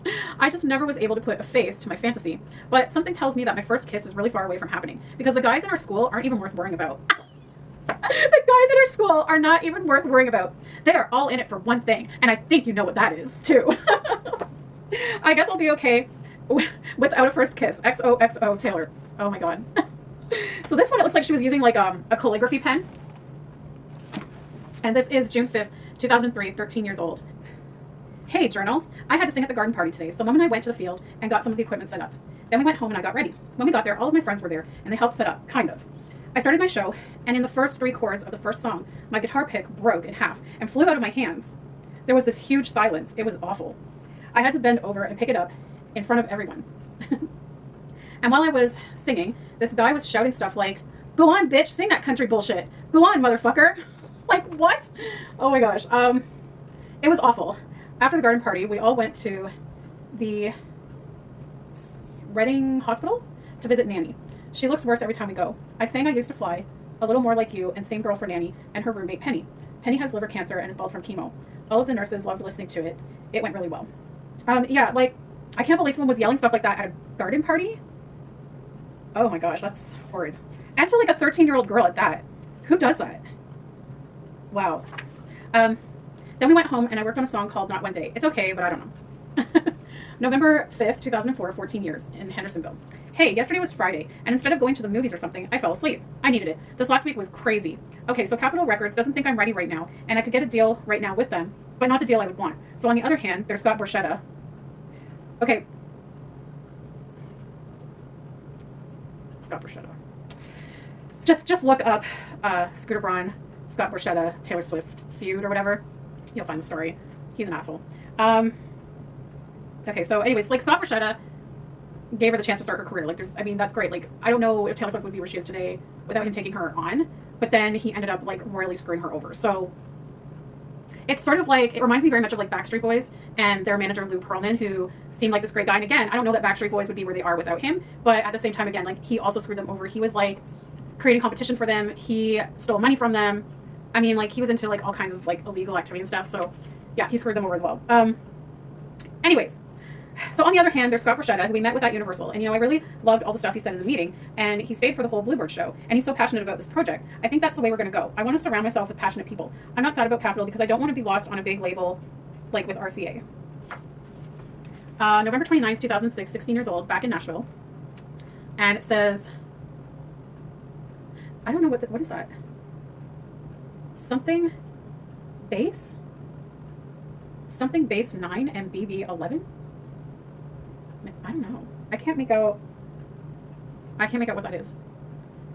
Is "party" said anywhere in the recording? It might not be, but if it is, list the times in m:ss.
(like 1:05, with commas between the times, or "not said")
0:29, 0:58, 1:17.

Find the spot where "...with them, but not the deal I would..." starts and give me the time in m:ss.
1:41.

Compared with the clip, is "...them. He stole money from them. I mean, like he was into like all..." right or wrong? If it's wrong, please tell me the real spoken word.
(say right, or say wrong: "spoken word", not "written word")
right.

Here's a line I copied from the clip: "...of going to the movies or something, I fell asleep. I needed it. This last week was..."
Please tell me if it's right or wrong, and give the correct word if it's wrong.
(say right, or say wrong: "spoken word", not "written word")
right.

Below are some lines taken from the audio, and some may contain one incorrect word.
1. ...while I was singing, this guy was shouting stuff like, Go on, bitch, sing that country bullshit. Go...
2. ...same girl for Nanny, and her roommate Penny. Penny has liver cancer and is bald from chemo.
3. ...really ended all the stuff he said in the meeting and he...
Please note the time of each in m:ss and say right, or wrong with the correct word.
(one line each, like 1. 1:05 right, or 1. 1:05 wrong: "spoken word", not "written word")
1. 0:48 right
2. 1:07 right
3. 2:32 wrong: "loved", not "ended".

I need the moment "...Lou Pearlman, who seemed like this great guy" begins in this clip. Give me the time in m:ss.
2:14.